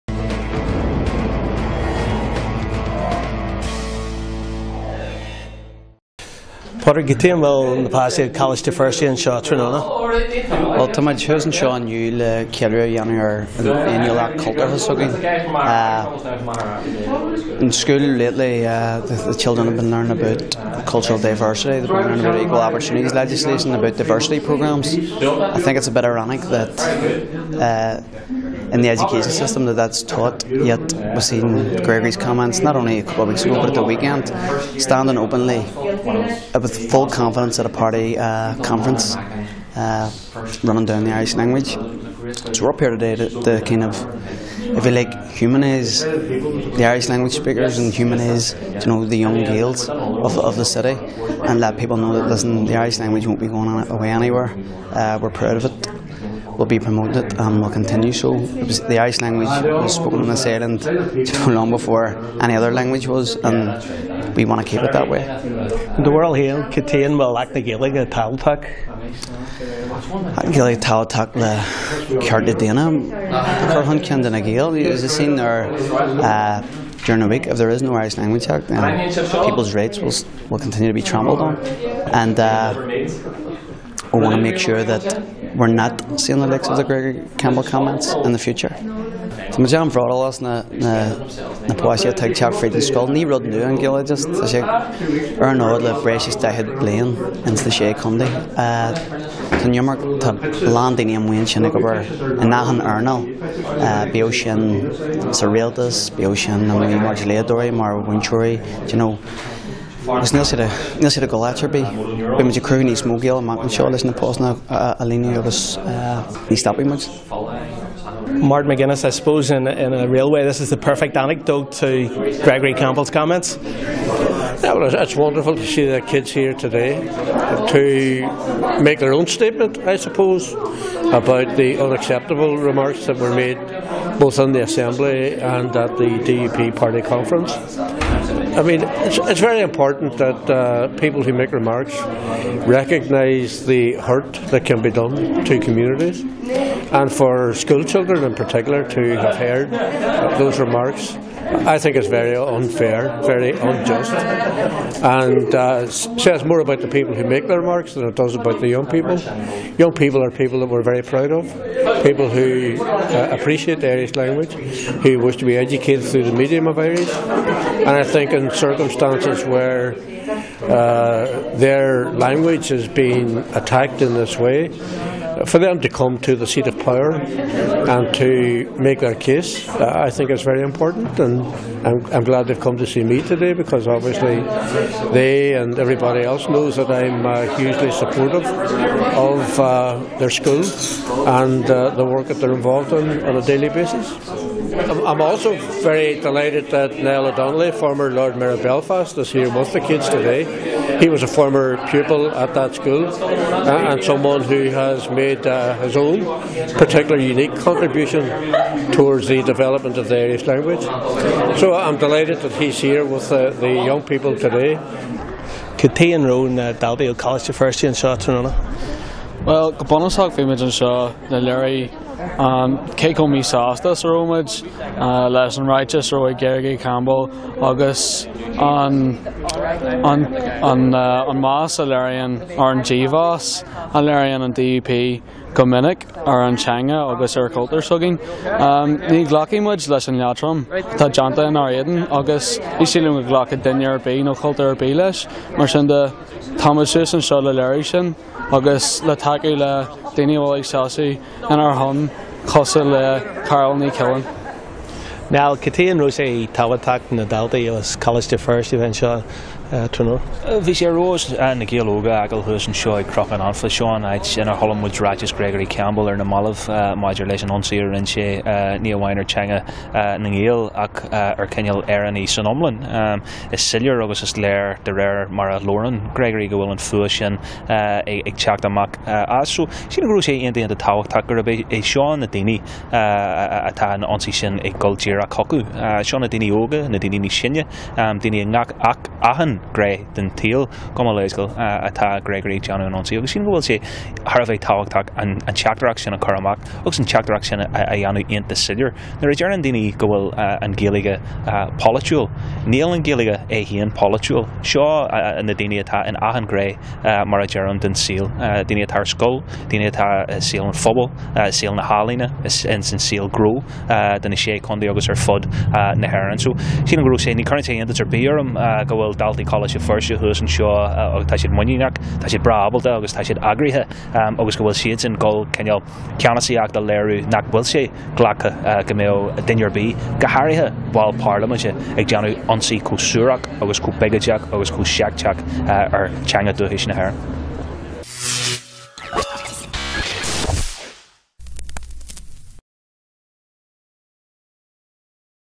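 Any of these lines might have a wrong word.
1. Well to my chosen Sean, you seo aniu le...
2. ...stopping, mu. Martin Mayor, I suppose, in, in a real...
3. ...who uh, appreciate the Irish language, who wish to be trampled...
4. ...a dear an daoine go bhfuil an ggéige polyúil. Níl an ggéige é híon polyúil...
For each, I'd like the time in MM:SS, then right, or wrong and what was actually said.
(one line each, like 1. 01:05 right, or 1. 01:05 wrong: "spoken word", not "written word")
1. 00:10 right
2. 01:56 wrong: "McGuinness", not "Mayor"
3. 02:42 wrong: "educated", not "trampled"
4. 04:59 right.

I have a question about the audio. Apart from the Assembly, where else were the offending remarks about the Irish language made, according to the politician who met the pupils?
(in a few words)
DUP party conference.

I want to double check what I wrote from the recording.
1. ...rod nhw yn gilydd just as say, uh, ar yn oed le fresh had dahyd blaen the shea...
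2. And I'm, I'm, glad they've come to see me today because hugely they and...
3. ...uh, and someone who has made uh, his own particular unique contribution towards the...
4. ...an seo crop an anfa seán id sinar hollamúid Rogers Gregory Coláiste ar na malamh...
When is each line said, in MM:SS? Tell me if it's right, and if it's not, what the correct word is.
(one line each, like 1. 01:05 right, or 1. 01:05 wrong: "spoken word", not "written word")
1. 01:33 right
2. 03:01 wrong: "obviously", not "hugely"
3. 03:23 right
4. 04:22 wrong: "Campbell", not "Coláiste".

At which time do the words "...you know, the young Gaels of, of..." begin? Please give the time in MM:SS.
00:48.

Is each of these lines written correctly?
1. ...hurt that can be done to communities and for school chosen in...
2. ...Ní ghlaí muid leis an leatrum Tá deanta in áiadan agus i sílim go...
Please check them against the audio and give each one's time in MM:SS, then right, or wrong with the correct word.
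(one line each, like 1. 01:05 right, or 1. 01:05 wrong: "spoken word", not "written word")
1. 02:23 wrong: "children", not "chosen"
2. 03:59 right.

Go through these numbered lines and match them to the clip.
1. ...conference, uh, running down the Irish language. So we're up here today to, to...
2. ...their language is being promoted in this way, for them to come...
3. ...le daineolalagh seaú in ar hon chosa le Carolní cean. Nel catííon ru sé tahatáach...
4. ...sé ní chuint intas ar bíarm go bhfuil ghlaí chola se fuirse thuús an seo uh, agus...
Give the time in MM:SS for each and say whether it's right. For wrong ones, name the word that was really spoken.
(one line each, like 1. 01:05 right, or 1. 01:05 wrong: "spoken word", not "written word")
1. 00:38 right
2. 02:51 wrong: "attacked", not "promoted"
3. 04:09 right
4. 05:17 wrong: "daltaí", not "ghlaí".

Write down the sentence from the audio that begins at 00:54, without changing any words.
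Uh, we're proud of it will be promoted and will continue.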